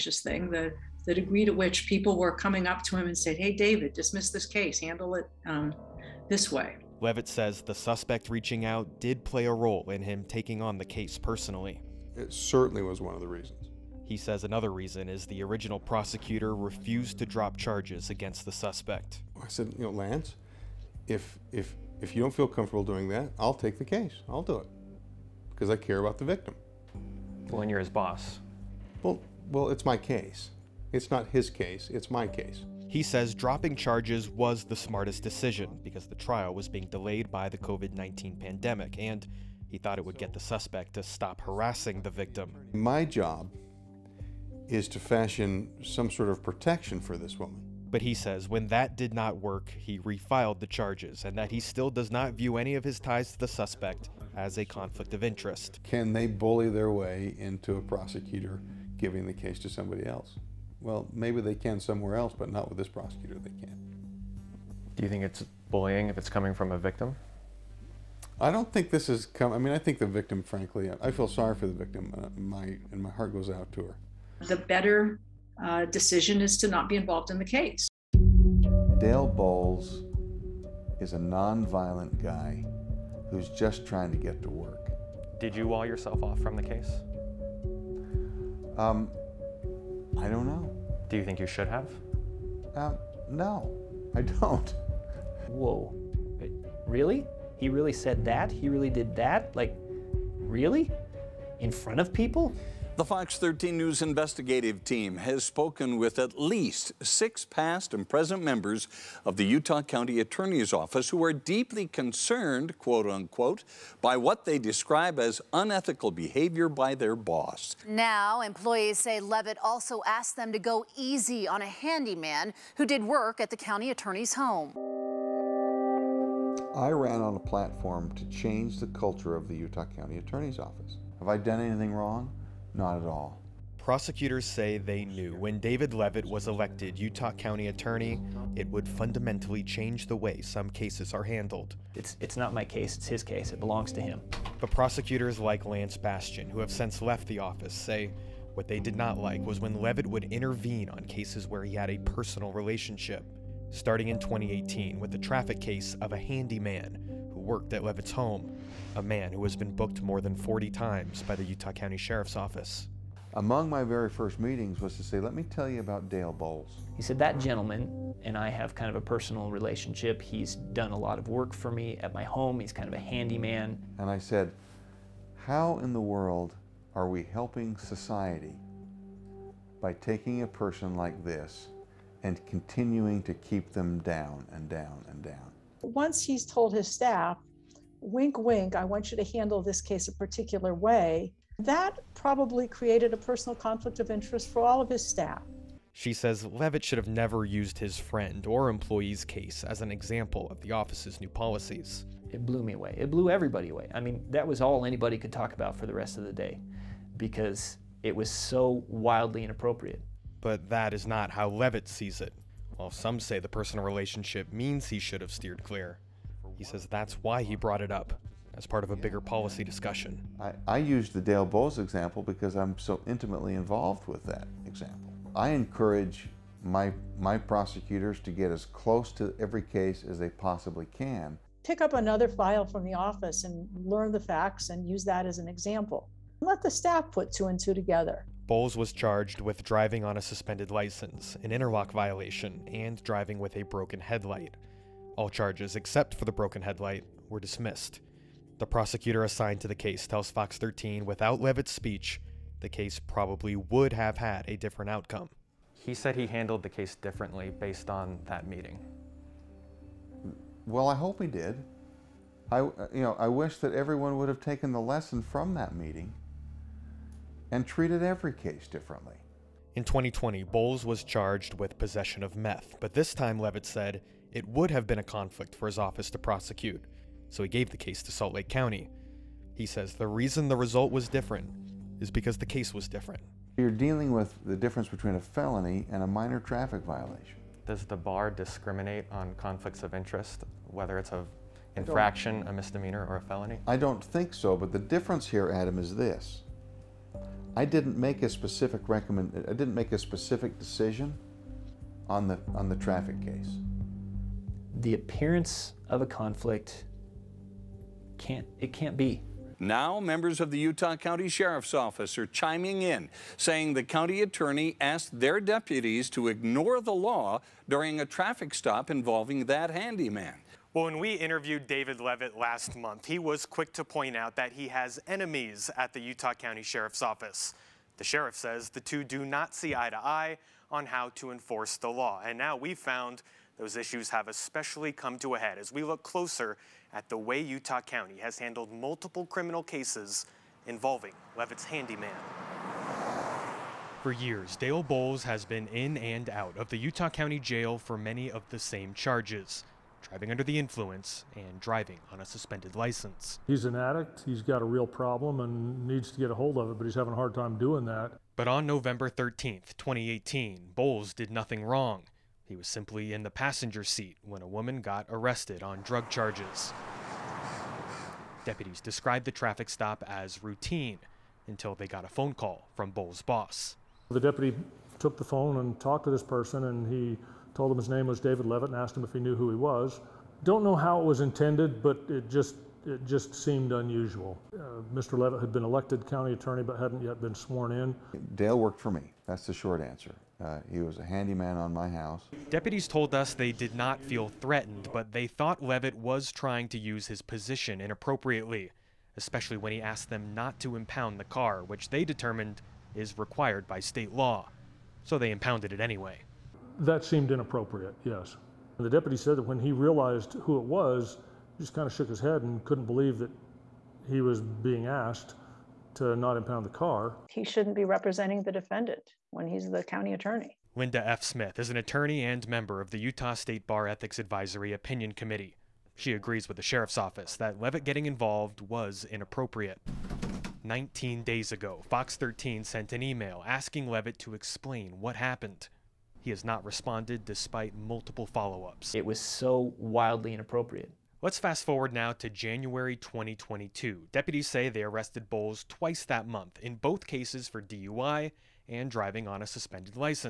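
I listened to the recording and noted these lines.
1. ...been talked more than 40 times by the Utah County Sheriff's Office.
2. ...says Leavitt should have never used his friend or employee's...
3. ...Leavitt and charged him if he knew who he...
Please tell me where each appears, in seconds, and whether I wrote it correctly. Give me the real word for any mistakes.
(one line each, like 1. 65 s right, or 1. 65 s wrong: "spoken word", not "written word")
1. 159 s wrong: "booked", not "talked"
2. 196 s right
3. 378 s wrong: "asked", not "charged".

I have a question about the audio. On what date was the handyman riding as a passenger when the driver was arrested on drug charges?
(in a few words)
November 13, 2018.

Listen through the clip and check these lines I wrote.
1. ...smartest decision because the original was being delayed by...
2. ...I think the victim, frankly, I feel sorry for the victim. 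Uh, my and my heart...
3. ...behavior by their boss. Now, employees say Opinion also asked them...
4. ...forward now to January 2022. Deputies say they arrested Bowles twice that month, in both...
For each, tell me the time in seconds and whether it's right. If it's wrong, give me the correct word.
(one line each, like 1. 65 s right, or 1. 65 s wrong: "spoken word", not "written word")
1. 34 s wrong: "trial", not "original"
2. 69 s right
3. 116 s wrong: "Leavitt", not "Opinion"
4. 441 s right.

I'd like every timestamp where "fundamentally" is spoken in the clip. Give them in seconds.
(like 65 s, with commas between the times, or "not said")
138 s.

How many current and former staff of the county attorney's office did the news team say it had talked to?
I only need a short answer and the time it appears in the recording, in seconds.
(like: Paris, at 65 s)
6, at 107 s.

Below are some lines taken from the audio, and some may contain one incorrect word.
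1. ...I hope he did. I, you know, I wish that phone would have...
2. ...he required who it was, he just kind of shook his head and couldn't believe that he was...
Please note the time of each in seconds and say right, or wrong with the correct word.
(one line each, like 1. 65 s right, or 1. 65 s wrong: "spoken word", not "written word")
1. 260 s wrong: "everyone", not "phone"
2. 409 s wrong: "realized", not "required".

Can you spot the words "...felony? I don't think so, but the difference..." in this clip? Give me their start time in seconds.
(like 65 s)
293 s.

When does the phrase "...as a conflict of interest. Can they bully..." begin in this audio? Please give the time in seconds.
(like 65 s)
54 s.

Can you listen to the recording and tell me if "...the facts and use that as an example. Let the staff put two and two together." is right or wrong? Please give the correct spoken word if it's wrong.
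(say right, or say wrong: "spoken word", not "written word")
right.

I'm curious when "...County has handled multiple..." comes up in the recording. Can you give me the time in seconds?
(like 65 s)
337 s.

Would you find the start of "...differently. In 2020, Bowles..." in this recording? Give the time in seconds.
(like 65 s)
268 s.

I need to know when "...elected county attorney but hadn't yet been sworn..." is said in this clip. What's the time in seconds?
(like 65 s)
385 s.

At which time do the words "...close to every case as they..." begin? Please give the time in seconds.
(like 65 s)
228 s.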